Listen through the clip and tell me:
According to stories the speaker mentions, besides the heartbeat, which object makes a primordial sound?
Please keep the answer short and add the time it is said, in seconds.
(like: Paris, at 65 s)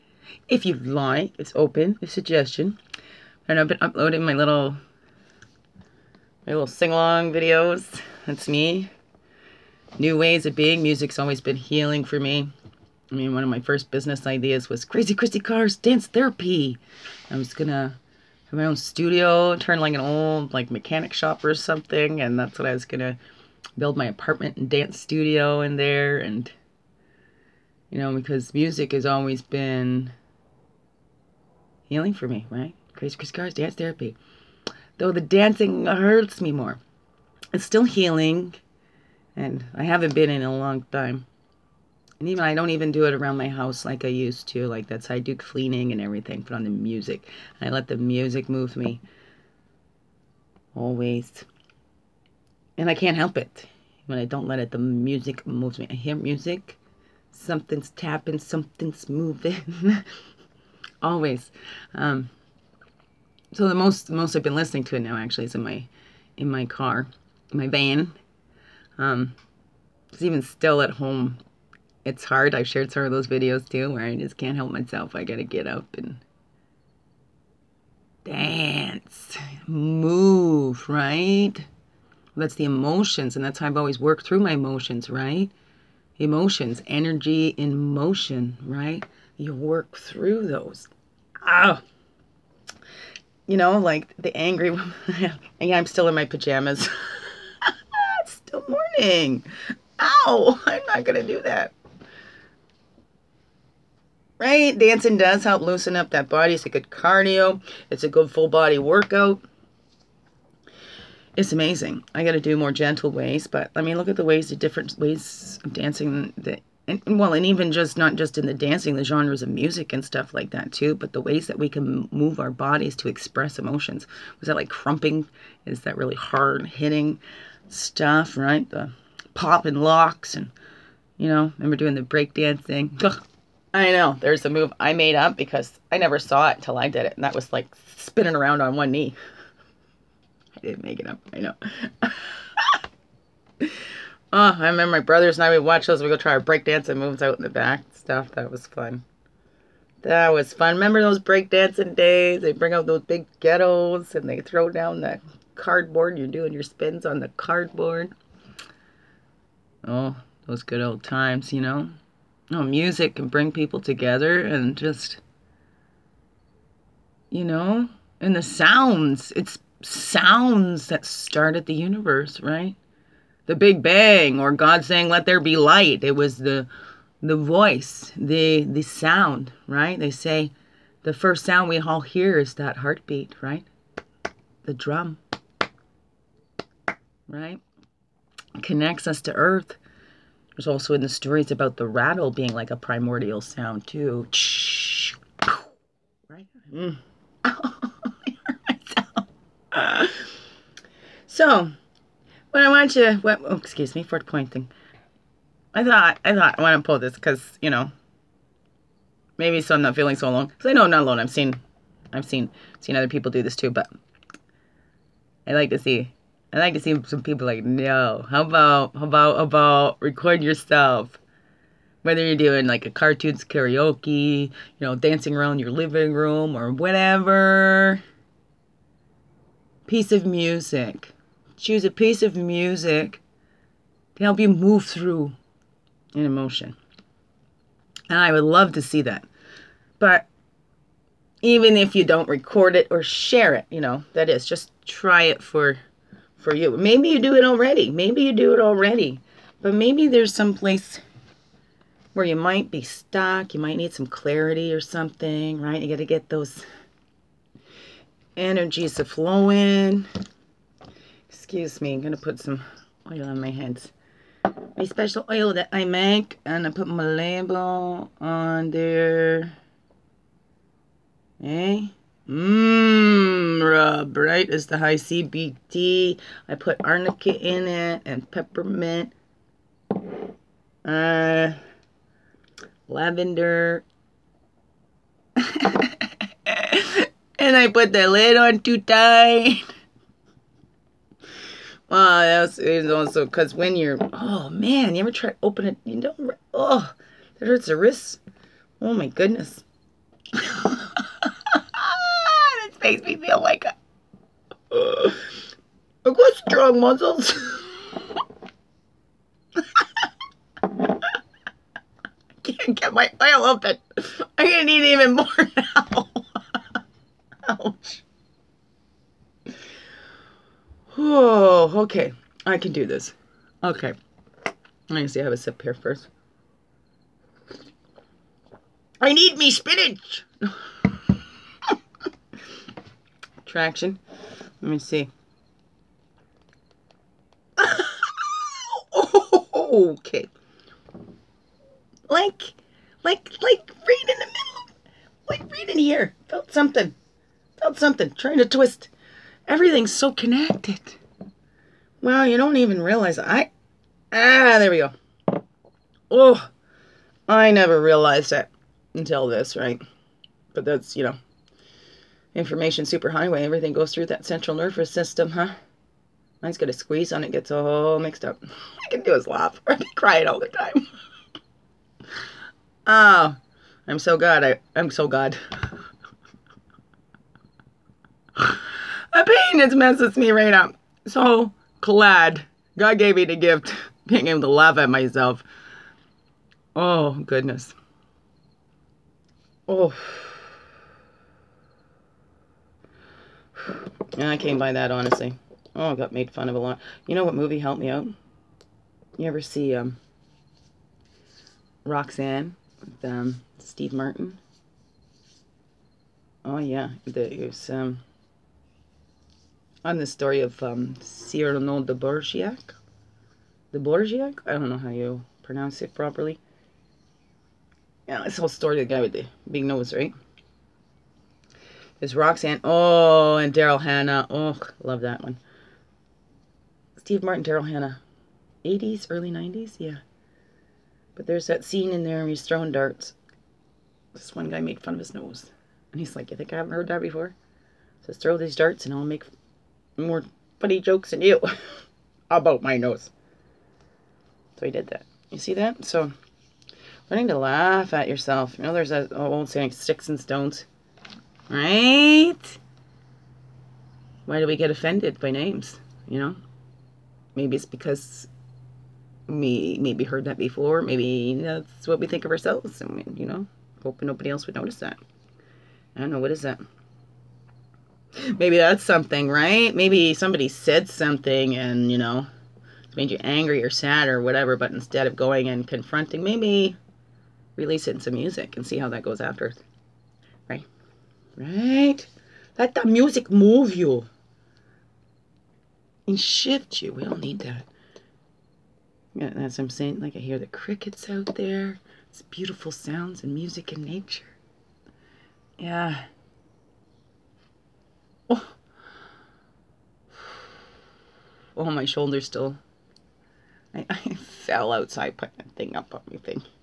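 the rattle, at 191 s.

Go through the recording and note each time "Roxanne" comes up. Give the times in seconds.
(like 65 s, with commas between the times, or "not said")
401 s, 422 s.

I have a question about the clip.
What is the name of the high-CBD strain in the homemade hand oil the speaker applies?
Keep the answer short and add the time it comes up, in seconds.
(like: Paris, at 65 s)
Amra Bright, at 273 s.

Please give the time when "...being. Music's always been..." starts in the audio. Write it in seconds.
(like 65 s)
10 s.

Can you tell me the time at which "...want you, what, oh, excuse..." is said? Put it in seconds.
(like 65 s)
202 s.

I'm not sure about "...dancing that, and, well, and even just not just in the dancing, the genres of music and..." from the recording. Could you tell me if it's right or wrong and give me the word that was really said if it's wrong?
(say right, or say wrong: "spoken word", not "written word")
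right.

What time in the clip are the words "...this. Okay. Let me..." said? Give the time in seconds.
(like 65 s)
322 s.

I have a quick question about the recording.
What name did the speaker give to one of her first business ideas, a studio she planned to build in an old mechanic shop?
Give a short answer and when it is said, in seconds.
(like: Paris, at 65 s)
Crazy Christy Cars Dance Therapy, at 14 s.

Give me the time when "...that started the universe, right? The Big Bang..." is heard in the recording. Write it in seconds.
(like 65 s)
170 s.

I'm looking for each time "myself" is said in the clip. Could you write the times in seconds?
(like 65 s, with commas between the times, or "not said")
74 s, 384 s.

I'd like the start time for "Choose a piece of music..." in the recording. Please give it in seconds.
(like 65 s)
231 s.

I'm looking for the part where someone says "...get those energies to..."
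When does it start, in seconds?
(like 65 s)
256 s.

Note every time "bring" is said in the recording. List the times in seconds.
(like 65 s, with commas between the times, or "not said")
152 s, 163 s.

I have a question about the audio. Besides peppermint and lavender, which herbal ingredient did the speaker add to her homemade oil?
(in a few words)
arnica.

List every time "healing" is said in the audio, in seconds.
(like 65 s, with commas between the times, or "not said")
11 s, 31 s, 37 s.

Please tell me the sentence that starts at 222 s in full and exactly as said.
Whether you're doing like a cartoons karaoke, you know, dancing around your living room or whatever.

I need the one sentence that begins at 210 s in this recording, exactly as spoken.
Because I know I'm not alone.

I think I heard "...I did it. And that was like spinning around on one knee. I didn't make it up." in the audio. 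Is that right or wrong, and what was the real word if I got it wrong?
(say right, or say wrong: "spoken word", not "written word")
right.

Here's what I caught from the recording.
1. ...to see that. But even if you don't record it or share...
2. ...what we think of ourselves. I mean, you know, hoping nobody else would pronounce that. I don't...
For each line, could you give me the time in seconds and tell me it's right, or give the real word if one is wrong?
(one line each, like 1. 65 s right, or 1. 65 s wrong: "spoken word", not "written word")
1. 238 s right
2. 461 s wrong: "notice", not "pronounce".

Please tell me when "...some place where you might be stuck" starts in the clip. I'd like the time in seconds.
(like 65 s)
250 s.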